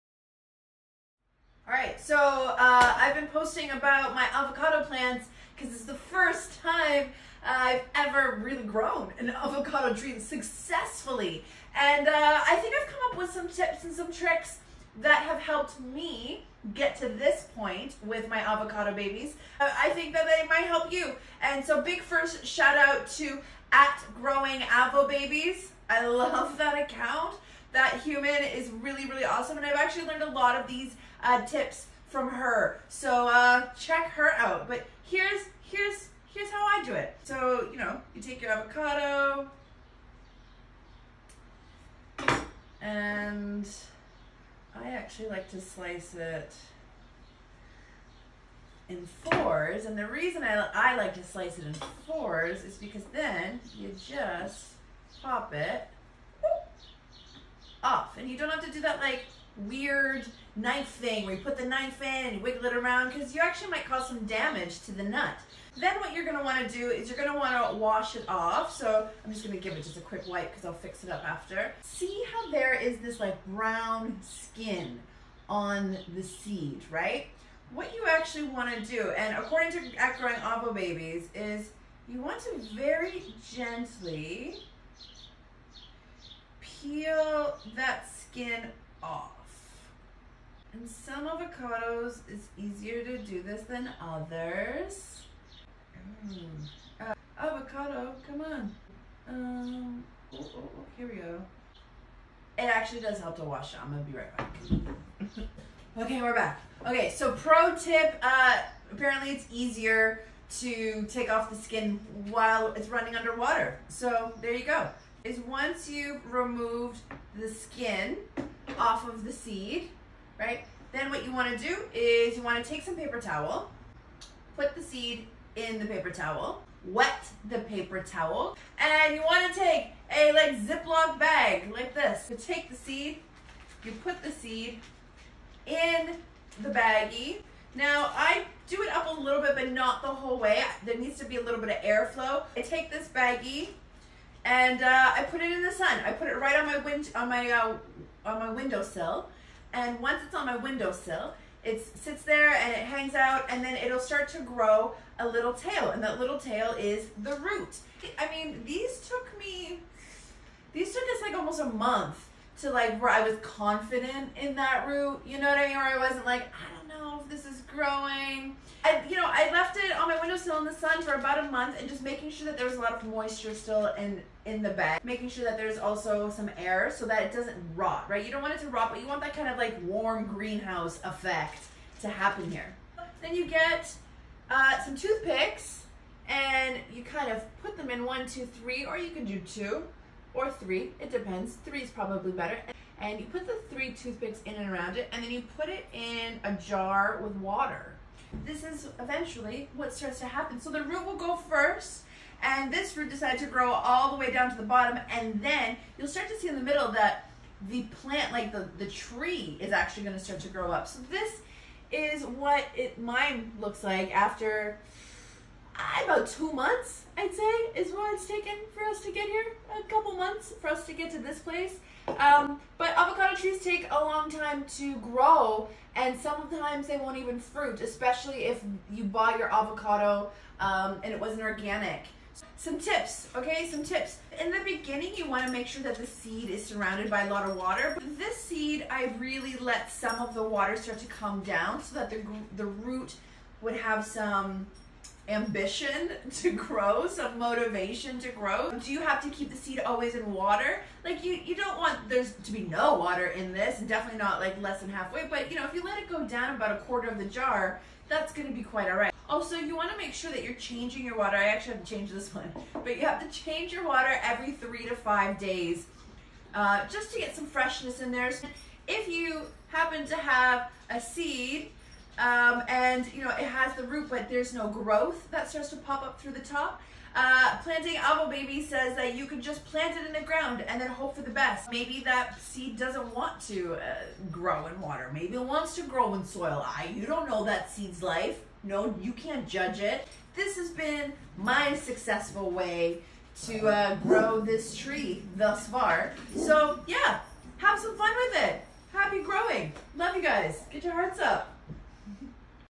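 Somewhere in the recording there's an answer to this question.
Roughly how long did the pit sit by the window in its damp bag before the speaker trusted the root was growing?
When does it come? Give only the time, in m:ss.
2:41.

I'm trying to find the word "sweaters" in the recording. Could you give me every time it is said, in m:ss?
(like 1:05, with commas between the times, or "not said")
not said.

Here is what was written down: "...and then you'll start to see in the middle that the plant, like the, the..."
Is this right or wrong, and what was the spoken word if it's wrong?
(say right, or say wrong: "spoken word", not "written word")
right.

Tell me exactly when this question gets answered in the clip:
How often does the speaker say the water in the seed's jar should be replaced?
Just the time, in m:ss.
4:24.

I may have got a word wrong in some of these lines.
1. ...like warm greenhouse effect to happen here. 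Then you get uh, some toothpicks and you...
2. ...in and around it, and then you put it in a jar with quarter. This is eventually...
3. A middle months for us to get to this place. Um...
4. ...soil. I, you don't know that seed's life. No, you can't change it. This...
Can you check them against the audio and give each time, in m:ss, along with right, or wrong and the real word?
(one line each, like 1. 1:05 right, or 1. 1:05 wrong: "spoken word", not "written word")
1. 2:59 right
2. 3:14 wrong: "water", not "quarter"
3. 3:39 wrong: "couple", not "middle"
4. 4:46 wrong: "judge", not "change".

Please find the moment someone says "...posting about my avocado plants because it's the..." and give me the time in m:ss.
0:03.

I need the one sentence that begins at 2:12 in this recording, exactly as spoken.
You take the seed, you put the seed in the baggie.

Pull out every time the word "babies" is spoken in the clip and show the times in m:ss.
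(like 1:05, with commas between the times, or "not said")
0:18, 0:25, 1:20.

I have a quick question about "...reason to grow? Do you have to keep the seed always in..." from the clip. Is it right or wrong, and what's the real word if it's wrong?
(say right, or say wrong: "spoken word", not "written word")
wrong: "motivation", not "reason".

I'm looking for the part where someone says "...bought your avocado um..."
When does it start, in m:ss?
3:49.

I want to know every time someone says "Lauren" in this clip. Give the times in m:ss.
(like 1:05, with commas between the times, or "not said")
not said.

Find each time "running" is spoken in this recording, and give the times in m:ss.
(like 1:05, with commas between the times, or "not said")
1:52.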